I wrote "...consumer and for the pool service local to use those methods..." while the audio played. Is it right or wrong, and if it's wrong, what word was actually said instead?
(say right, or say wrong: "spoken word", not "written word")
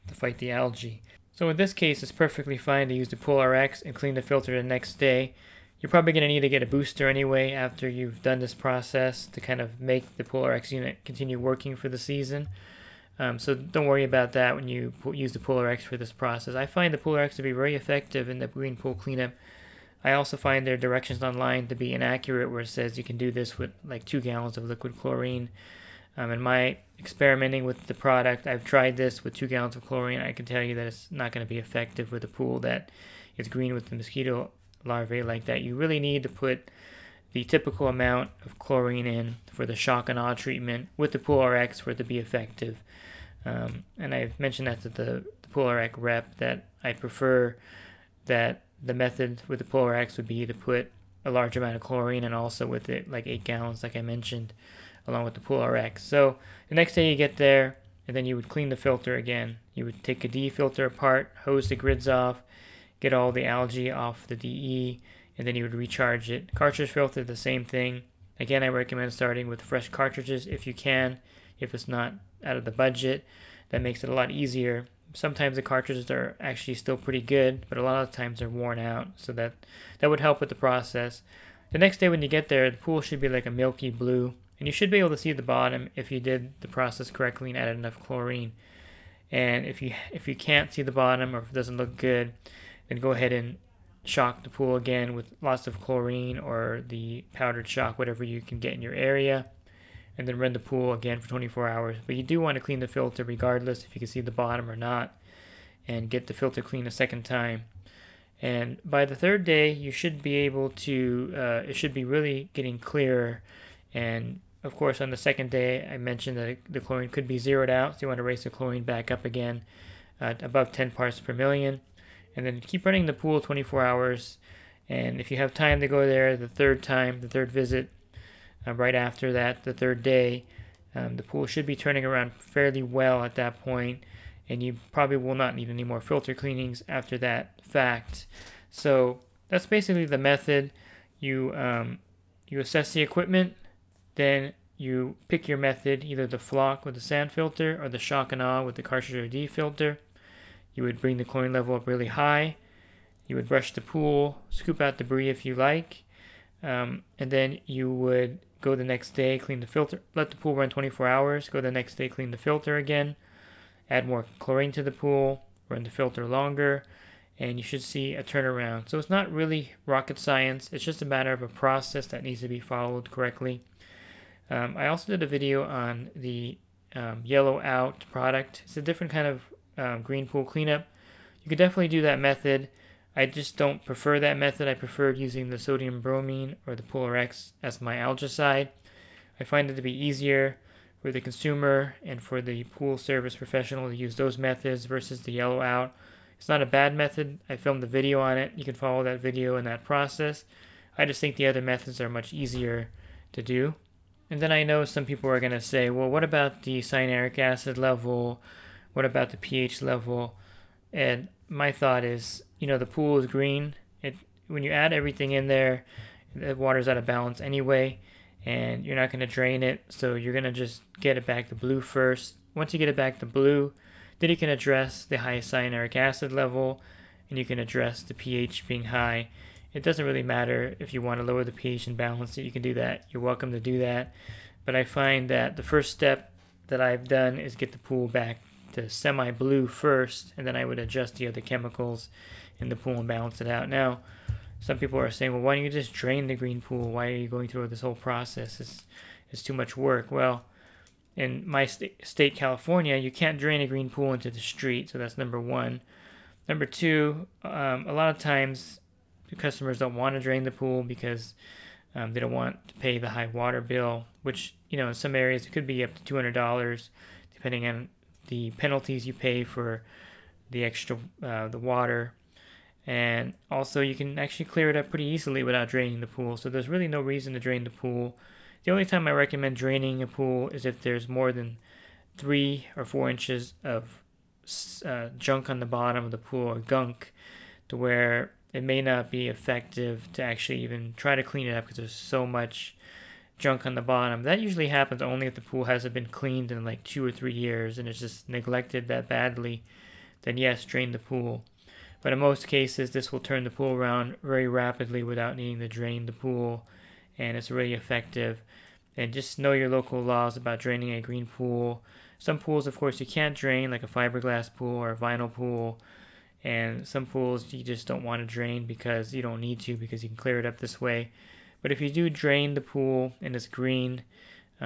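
wrong: "professional", not "local".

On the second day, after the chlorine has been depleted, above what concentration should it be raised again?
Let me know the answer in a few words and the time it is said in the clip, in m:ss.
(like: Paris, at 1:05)
10 parts per million, at 2:00.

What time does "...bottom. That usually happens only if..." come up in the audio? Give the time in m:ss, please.
4:53.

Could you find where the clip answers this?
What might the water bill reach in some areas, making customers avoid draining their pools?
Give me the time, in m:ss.
4:26.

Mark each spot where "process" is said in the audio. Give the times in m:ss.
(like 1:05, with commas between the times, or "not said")
0:08, 0:16, 1:20, 1:26, 2:51, 3:19, 4:07.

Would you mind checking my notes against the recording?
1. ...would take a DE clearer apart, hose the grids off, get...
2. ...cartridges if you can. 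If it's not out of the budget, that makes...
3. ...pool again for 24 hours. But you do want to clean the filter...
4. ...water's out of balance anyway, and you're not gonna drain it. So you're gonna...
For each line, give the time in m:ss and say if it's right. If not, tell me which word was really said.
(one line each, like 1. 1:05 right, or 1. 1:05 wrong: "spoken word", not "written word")
1. 0:59 wrong: "filter", not "clearer"
2. 1:09 right
3. 1:40 right
4. 3:36 right.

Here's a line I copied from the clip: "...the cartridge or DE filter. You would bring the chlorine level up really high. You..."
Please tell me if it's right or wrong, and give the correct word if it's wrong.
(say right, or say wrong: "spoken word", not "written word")
right.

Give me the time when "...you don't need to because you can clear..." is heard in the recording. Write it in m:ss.
5:19.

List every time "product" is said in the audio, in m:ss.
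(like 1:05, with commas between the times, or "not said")
0:27, 2:58.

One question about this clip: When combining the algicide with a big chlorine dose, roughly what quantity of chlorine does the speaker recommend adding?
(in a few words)
8 gallons.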